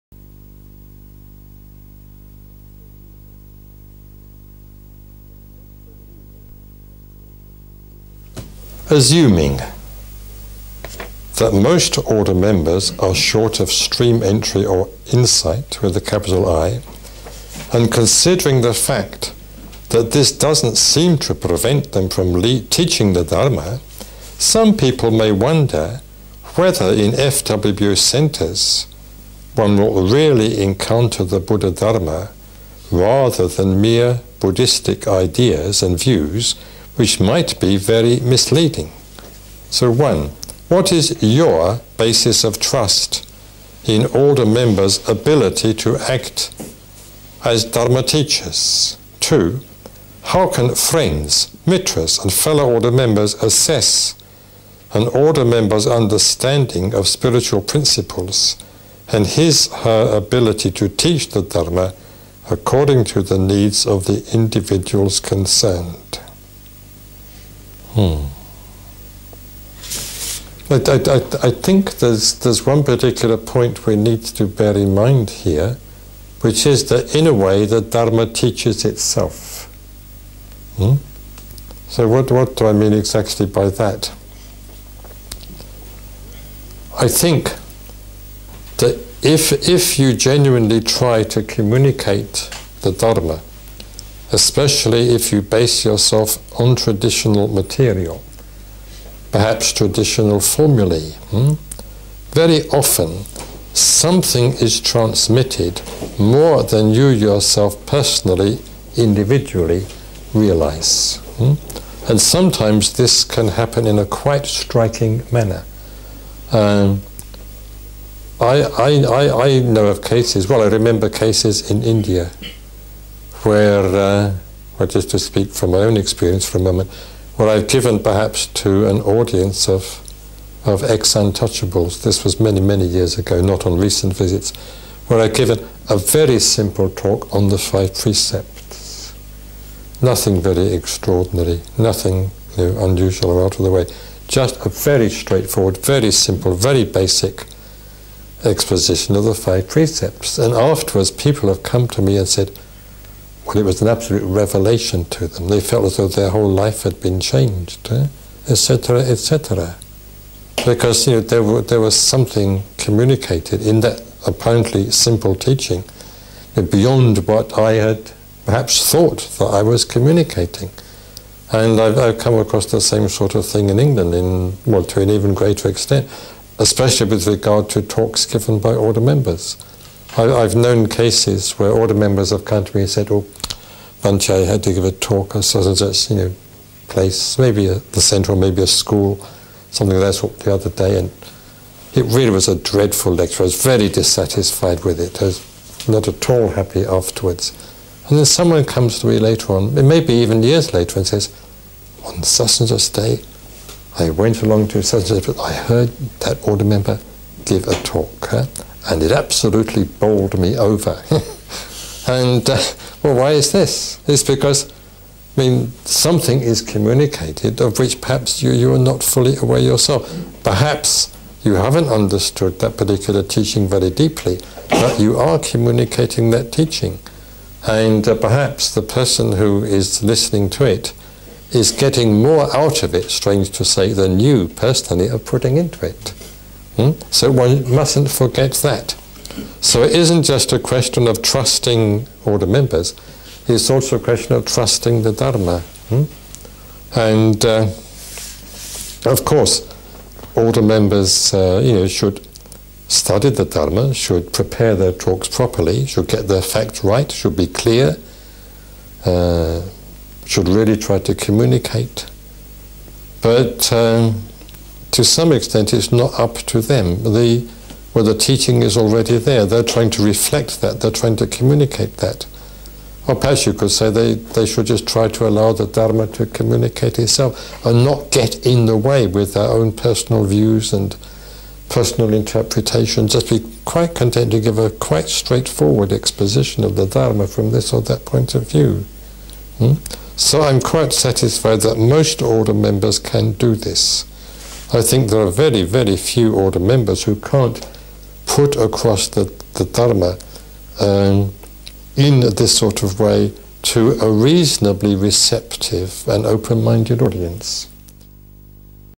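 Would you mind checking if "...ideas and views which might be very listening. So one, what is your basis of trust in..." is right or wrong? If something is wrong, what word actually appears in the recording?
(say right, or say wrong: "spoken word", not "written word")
wrong: "misleading", not "listening".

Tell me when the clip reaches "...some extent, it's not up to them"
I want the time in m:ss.
4:25.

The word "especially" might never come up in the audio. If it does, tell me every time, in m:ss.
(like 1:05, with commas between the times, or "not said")
1:34, 2:56.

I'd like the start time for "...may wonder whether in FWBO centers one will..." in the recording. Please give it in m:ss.
0:25.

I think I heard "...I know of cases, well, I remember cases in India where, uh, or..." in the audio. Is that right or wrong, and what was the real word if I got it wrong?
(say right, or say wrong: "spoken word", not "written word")
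right.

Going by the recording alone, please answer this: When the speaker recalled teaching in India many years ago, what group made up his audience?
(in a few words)
Ex-untouchables.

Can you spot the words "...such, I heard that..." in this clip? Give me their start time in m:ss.
3:25.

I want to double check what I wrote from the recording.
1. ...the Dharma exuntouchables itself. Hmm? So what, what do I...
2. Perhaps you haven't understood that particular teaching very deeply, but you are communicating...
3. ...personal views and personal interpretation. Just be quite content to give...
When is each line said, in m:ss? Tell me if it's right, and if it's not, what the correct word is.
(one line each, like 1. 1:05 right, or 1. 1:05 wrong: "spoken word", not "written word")
1. 1:17 wrong: "teaches", not "exuntouchables"
2. 3:40 right
3. 4:39 right.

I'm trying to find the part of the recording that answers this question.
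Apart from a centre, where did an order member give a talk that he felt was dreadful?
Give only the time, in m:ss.
3:08.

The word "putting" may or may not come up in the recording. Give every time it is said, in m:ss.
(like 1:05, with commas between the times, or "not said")
3:55.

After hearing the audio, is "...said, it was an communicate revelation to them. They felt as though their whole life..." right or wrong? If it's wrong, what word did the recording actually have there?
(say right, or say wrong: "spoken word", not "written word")
wrong: "absolute", not "communicate".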